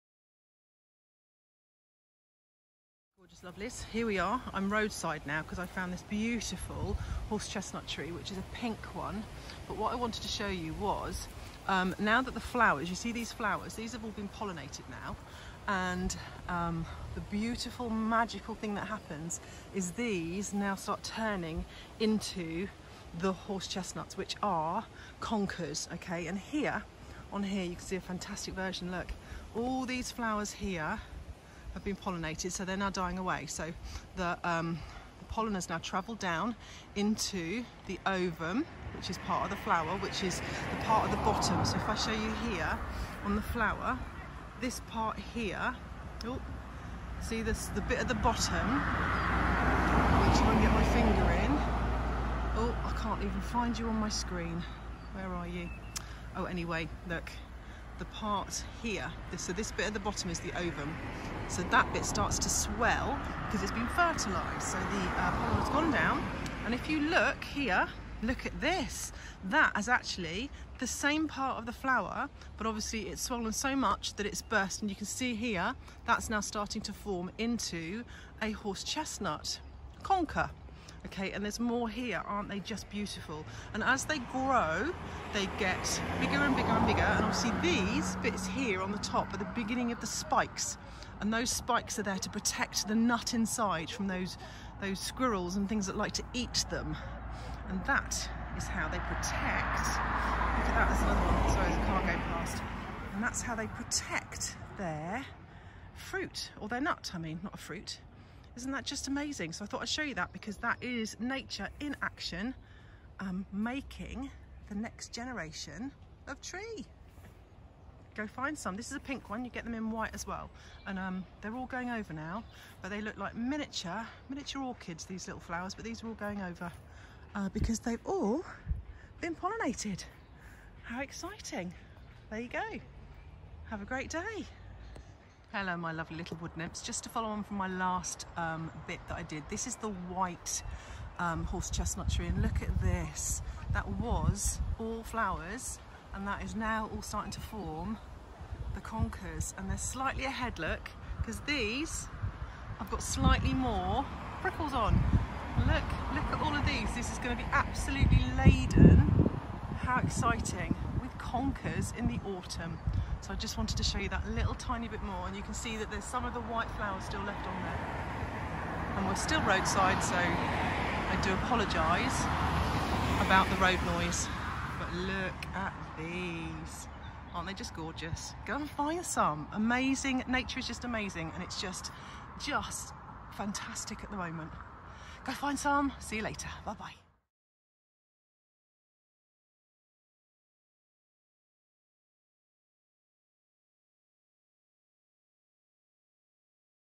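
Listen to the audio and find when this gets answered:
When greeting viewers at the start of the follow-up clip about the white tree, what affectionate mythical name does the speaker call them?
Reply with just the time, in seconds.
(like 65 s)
136 s.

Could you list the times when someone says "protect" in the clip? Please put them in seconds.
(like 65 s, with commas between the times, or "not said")
92 s, 98 s, 103 s.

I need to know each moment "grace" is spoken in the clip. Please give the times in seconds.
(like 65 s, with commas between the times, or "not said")
not said.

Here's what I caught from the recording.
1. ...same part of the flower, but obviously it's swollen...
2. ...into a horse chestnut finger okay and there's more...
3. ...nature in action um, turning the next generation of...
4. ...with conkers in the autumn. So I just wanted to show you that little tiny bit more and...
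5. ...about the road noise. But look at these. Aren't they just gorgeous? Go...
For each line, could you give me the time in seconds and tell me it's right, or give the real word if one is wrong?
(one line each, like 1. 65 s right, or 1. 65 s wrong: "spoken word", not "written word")
1. 70 s right
2. 77 s wrong: "conker", not "finger"
3. 111 s wrong: "making", not "turning"
4. 161 s right
5. 173 s right.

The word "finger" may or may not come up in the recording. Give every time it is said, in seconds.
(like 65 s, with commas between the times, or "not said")
50 s.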